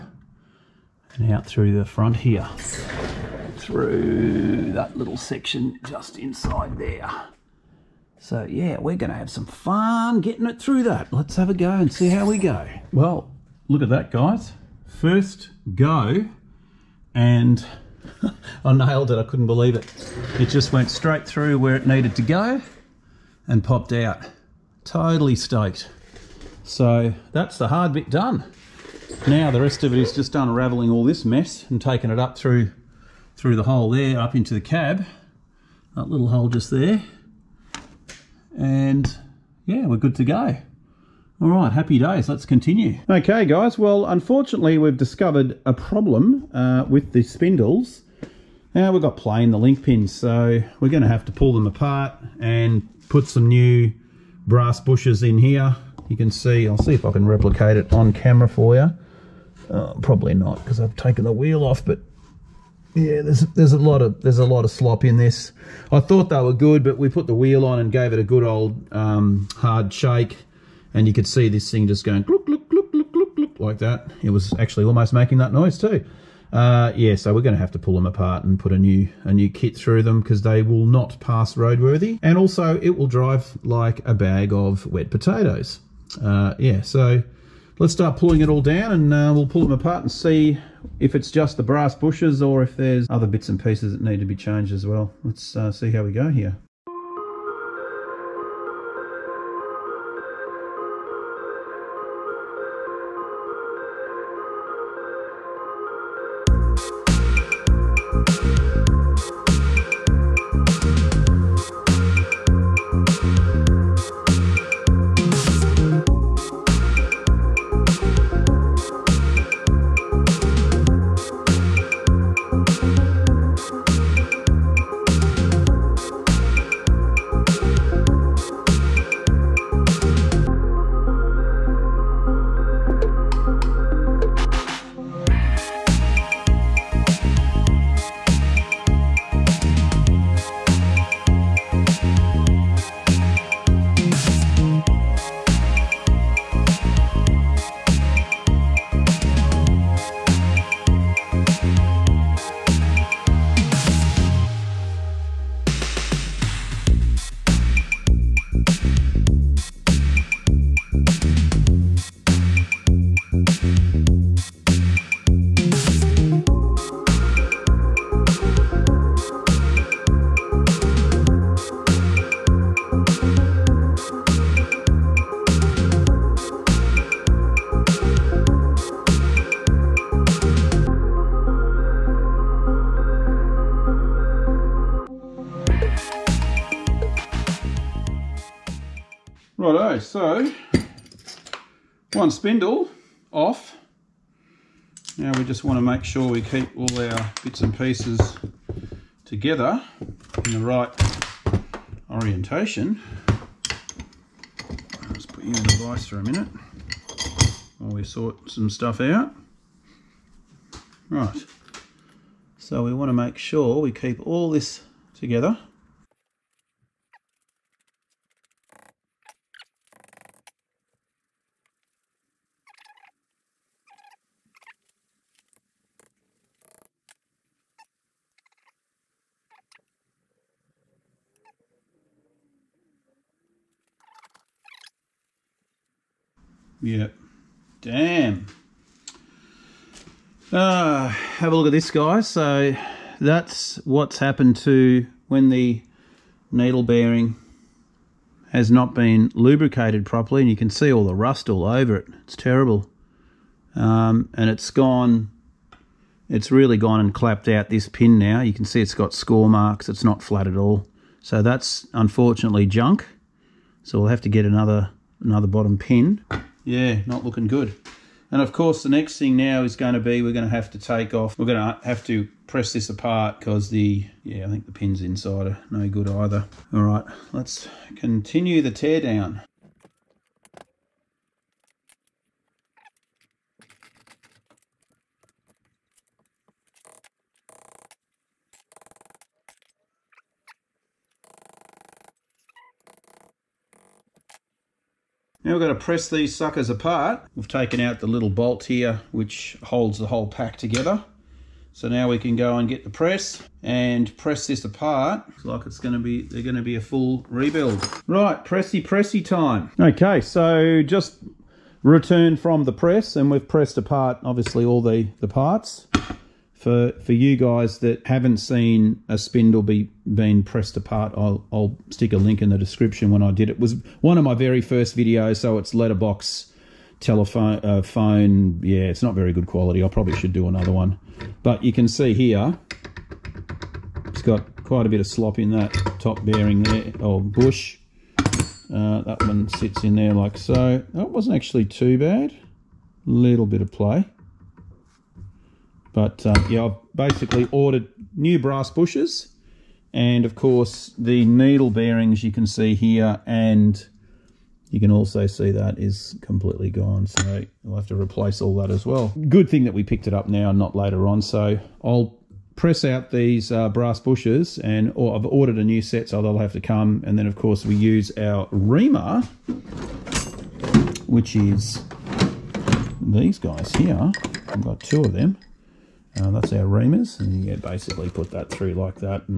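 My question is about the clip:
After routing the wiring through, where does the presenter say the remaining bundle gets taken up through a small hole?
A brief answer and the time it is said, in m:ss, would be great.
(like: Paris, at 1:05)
Into the cab, at 0:34.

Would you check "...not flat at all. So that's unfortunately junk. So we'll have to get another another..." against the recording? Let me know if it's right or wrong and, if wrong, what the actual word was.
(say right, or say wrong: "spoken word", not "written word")
right.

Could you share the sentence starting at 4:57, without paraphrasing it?
We've taken out the little bolt here, which holds the whole pack together.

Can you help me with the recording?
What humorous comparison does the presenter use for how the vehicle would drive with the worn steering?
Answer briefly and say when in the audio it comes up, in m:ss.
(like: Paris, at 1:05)
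A bag of wet potatoes, at 1:24.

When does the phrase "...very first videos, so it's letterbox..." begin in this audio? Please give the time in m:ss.
5:24.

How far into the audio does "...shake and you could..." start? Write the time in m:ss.
1:09.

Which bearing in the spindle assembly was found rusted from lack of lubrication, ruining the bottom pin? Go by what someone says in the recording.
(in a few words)
Needle bearing.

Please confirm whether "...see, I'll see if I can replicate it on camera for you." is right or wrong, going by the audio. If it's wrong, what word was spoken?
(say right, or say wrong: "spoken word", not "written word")
right.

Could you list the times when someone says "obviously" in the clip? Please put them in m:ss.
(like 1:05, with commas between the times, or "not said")
5:14.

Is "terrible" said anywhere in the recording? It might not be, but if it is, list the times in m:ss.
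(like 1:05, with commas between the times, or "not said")
4:12.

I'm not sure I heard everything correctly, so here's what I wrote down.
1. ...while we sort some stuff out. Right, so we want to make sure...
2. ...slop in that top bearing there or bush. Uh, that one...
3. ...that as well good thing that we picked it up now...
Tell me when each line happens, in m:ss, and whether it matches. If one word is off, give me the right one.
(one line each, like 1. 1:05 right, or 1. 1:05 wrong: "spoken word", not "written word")
1. 3:27 right
2. 5:35 right
3. 5:58 right.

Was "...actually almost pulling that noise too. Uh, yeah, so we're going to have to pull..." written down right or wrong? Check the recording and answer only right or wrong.
wrong.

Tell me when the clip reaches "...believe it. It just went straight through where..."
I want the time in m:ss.
0:19.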